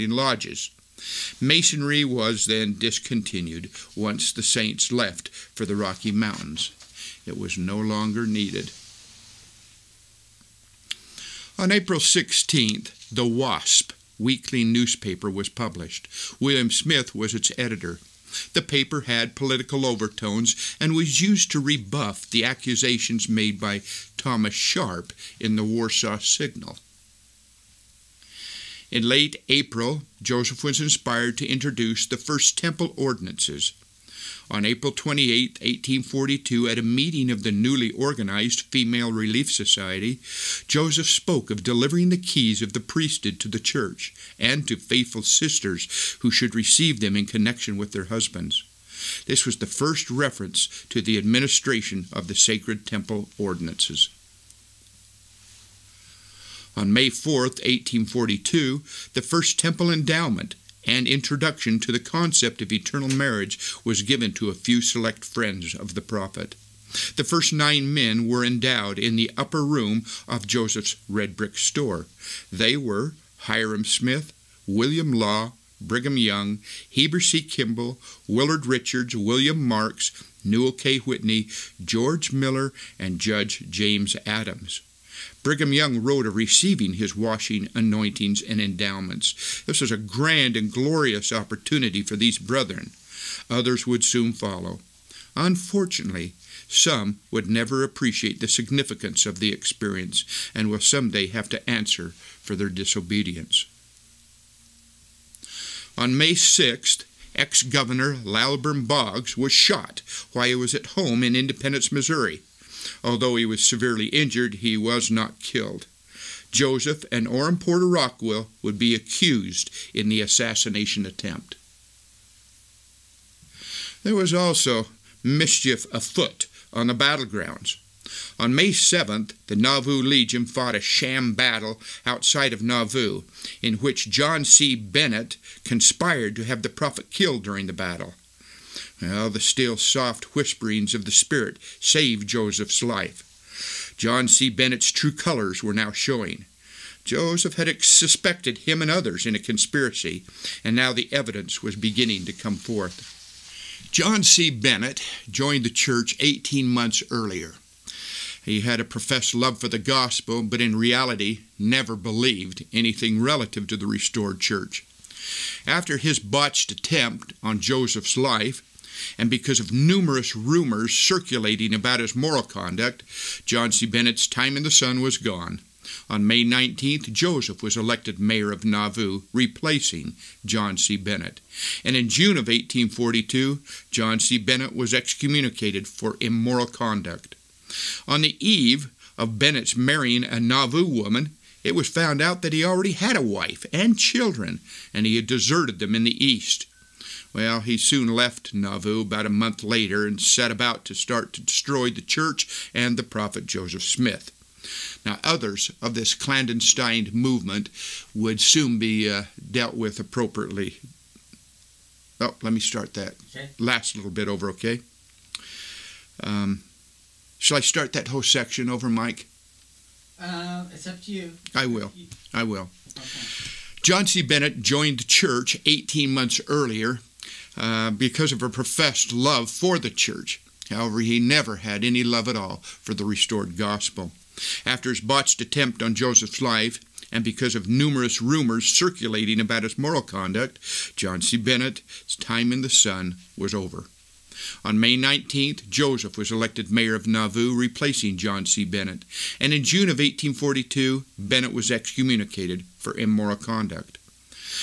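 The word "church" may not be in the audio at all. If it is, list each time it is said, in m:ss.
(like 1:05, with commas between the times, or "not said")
0:43, 2:35, 2:44, 3:21, 3:45, 3:49.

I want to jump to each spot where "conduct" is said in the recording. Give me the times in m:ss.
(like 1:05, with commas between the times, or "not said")
2:52, 3:06, 4:00, 4:13.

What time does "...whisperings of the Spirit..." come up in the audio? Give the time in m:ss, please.
2:20.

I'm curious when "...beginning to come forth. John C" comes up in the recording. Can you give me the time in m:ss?
2:31.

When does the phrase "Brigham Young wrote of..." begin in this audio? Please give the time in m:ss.
1:25.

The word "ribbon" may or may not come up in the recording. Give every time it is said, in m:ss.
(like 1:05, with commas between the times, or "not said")
not said.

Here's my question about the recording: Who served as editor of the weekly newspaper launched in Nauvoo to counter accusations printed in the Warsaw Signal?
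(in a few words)
William Smith.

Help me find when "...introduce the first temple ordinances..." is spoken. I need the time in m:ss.
0:31.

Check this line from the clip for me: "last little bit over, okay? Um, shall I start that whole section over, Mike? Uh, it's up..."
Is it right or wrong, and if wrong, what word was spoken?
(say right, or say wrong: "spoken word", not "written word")
right.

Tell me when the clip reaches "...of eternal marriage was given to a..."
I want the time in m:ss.
1:02.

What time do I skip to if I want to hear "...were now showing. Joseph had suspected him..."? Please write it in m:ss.
2:25.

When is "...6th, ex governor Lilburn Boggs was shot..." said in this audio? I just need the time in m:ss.
1:46.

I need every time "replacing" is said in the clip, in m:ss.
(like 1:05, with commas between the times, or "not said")
2:59, 4:07.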